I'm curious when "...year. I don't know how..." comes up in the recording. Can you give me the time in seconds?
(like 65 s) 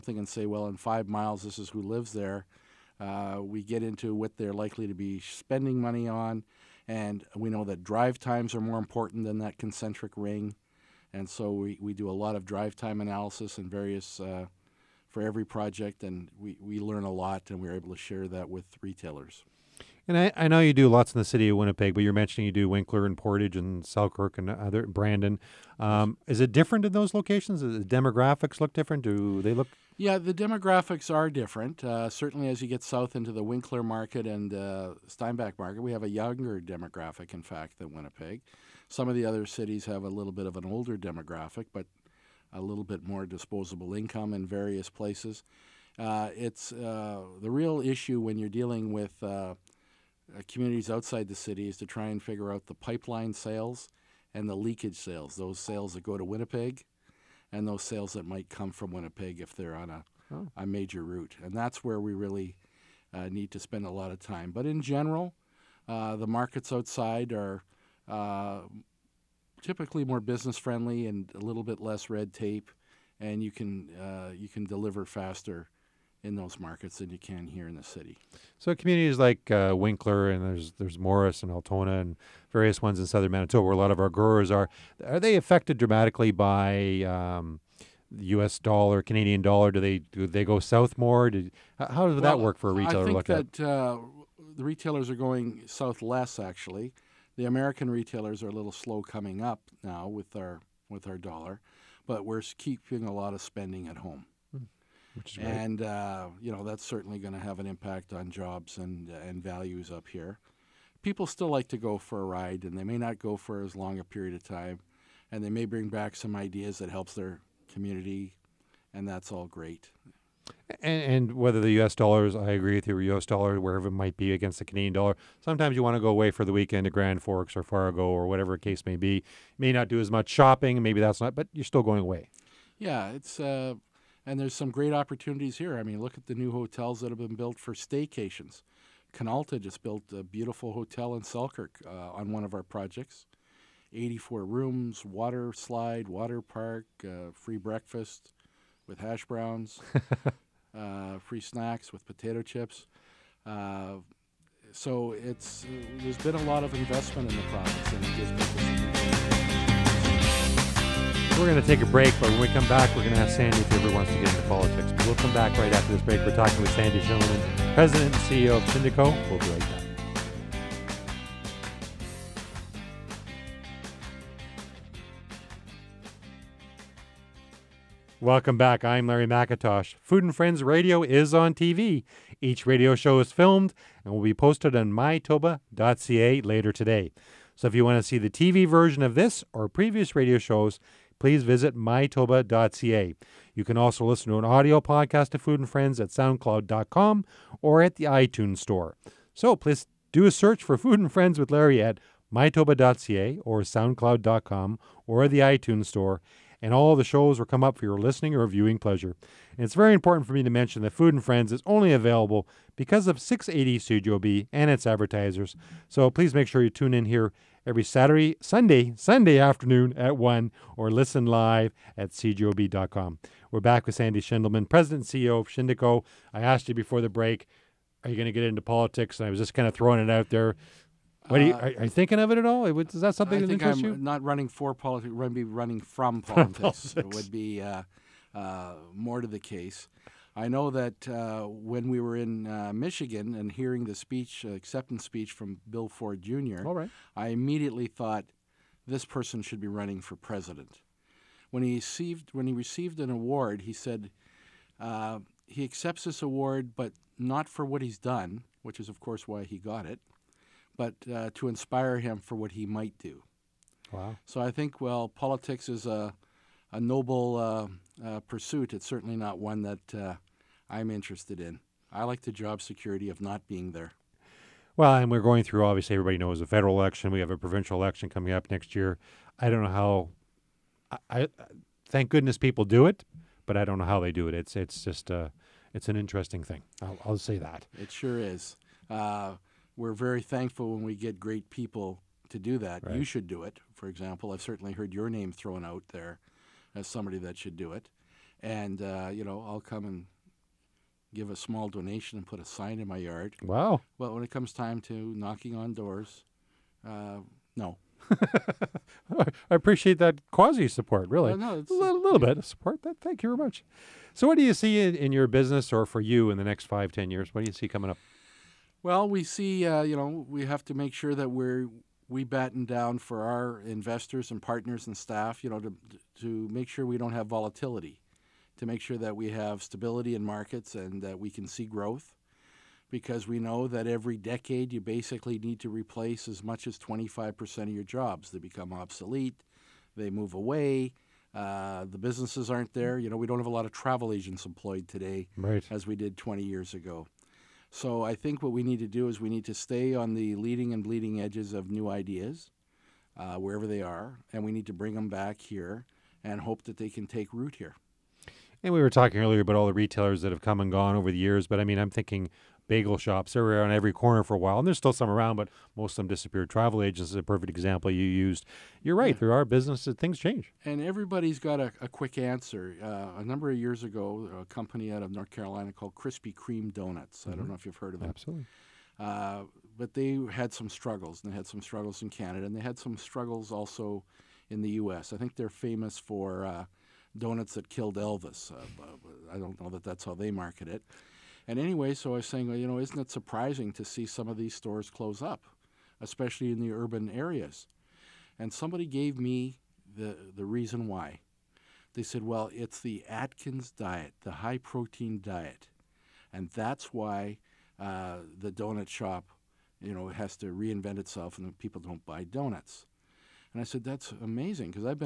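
278 s.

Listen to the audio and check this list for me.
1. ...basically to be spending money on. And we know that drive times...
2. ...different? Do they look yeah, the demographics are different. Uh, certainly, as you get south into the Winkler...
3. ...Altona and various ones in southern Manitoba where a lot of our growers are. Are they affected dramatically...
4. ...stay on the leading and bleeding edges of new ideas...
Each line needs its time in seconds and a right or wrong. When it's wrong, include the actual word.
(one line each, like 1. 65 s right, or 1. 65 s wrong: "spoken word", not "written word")
1. 4 s wrong: "likely", not "basically"
2. 28 s right
3. 81 s right
4. 349 s right.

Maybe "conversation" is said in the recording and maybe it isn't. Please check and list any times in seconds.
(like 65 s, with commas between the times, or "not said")
not said.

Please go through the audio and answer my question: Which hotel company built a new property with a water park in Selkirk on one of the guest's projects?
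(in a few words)
Canalta.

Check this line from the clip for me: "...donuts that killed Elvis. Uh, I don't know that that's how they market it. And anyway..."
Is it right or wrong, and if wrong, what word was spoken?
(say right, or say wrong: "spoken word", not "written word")
right.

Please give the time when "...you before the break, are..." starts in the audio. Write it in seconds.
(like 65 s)
226 s.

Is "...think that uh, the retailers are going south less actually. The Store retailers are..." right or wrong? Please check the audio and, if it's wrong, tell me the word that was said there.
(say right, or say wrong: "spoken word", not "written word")
wrong: "American", not "Store".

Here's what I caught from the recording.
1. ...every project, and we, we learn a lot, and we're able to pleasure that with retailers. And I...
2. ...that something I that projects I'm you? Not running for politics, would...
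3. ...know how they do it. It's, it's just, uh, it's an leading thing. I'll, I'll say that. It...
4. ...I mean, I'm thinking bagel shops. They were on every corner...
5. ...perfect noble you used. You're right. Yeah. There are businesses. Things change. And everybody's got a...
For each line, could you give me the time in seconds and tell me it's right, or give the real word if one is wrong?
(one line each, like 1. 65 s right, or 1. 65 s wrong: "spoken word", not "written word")
1. 15 s wrong: "share", not "pleasure"
2. 233 s wrong: "interests", not "projects"
3. 283 s wrong: "interesting", not "leading"
4. 361 s right
5. 367 s wrong: "example", not "noble".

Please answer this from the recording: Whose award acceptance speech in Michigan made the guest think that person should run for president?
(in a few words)
Bill Ford Jr.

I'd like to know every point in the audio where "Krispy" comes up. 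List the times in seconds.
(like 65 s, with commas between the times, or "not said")
375 s.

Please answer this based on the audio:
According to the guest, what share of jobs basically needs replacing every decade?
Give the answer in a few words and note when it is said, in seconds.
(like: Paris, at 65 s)
25%, at 336 s.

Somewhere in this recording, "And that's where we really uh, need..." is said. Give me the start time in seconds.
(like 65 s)
61 s.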